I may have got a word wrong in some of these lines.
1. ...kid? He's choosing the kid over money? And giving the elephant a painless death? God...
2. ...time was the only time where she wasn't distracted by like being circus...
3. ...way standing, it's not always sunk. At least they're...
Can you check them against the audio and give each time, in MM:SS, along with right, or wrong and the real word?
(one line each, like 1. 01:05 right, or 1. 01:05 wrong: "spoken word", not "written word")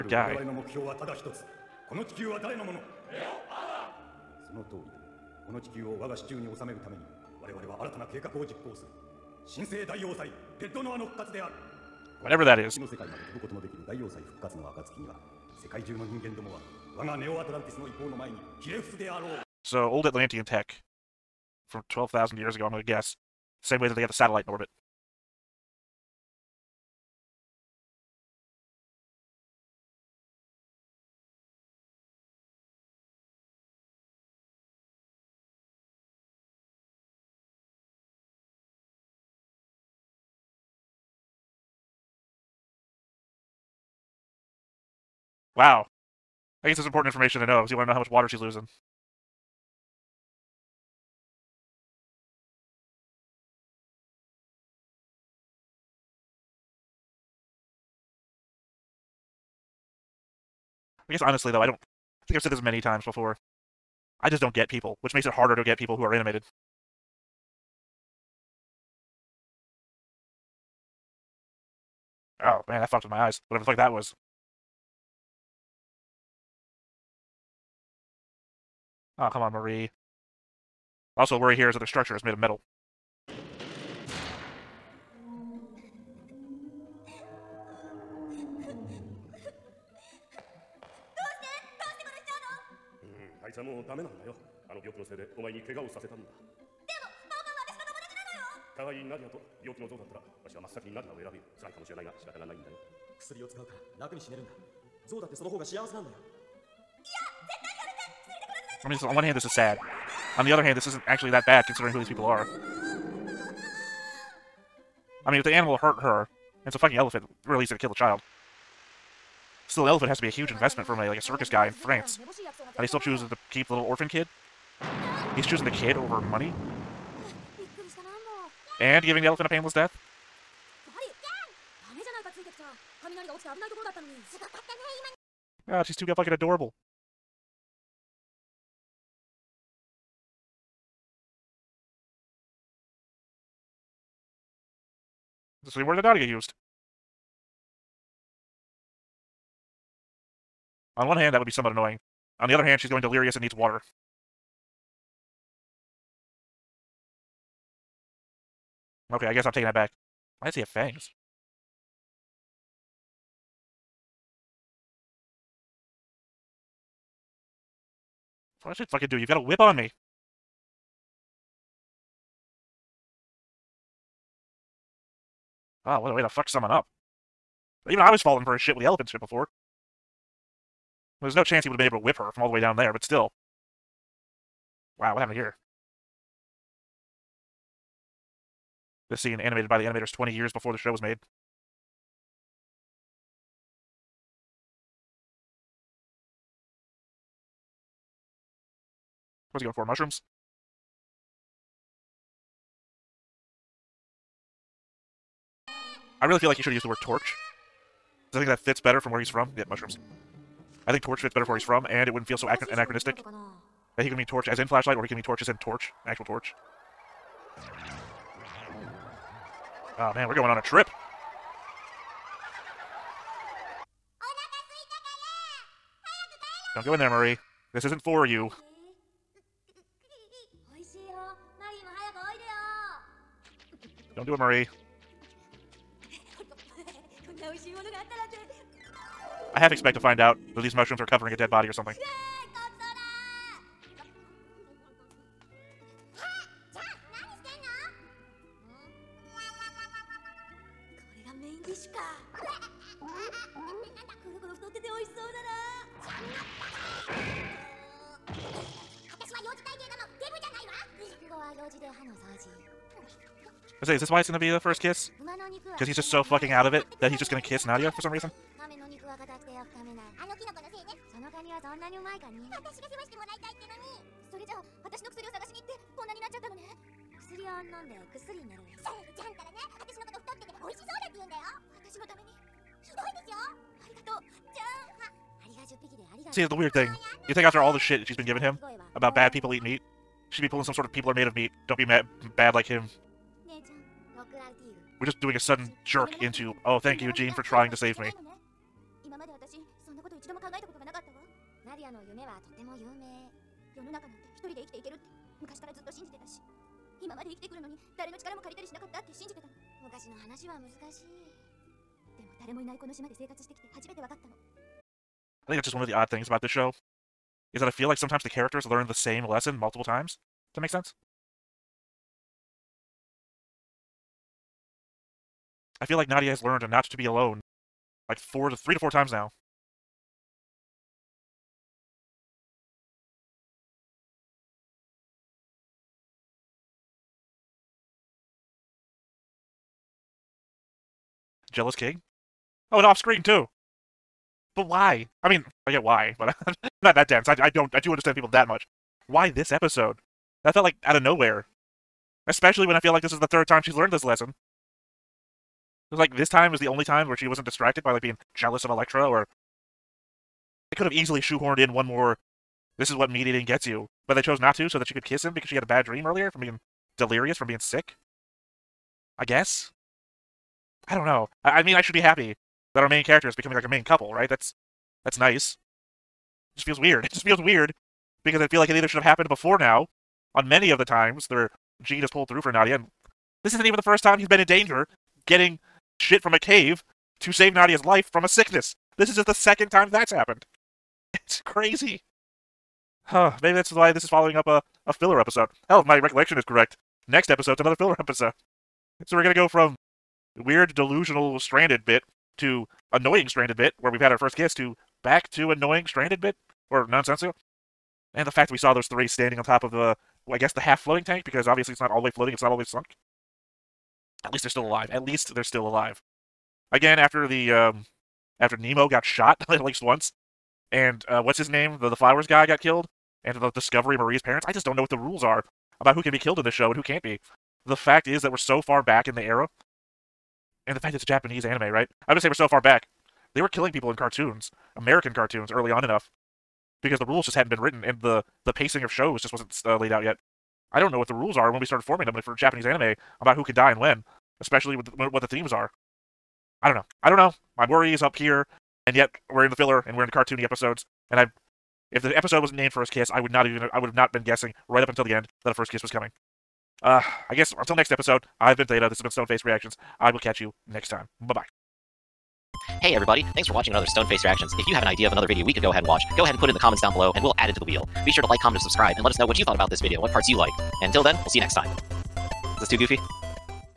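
1. 02:04 right
2. 05:56 wrong: "jealous", not "circus"
3. 06:52 wrong: "floating", not "standing".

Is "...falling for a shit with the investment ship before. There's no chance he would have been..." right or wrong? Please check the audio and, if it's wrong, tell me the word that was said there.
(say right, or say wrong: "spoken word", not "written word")
wrong: "elephant", not "investment".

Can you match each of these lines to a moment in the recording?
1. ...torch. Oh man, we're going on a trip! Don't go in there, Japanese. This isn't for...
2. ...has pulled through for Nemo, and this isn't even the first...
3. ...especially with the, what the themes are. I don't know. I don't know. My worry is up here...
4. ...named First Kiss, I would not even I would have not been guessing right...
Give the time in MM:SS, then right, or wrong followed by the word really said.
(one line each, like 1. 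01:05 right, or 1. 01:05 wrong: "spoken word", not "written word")
1. 03:36 wrong: "Marie", not "Japanese"
2. 06:22 wrong: "Nadia", not "Nemo"
3. 07:24 right
4. 07:32 right.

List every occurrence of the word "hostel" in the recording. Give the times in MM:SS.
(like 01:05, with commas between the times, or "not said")
not said.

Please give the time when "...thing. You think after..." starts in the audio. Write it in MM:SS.
04:46.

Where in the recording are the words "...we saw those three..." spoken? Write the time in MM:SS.
06:48.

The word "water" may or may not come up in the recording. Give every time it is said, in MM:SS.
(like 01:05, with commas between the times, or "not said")
00:48, 02:33.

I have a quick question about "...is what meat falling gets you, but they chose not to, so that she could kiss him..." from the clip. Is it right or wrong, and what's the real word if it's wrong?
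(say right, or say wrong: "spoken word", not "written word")
wrong: "eating", not "falling".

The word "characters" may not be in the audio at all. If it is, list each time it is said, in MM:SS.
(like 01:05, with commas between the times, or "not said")
05:18, 06:13.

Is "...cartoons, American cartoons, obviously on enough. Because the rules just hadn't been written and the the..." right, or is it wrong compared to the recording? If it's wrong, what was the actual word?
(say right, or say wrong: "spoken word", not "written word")
wrong: "early", not "obviously".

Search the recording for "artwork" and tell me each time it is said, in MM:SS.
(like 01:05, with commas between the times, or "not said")
not said.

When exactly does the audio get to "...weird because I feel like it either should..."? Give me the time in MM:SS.
06:17.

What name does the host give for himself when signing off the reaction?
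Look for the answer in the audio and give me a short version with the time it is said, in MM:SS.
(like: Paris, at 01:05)
Theta, at 07:38.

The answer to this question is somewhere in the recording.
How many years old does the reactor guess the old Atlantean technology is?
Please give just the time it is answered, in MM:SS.
00:21.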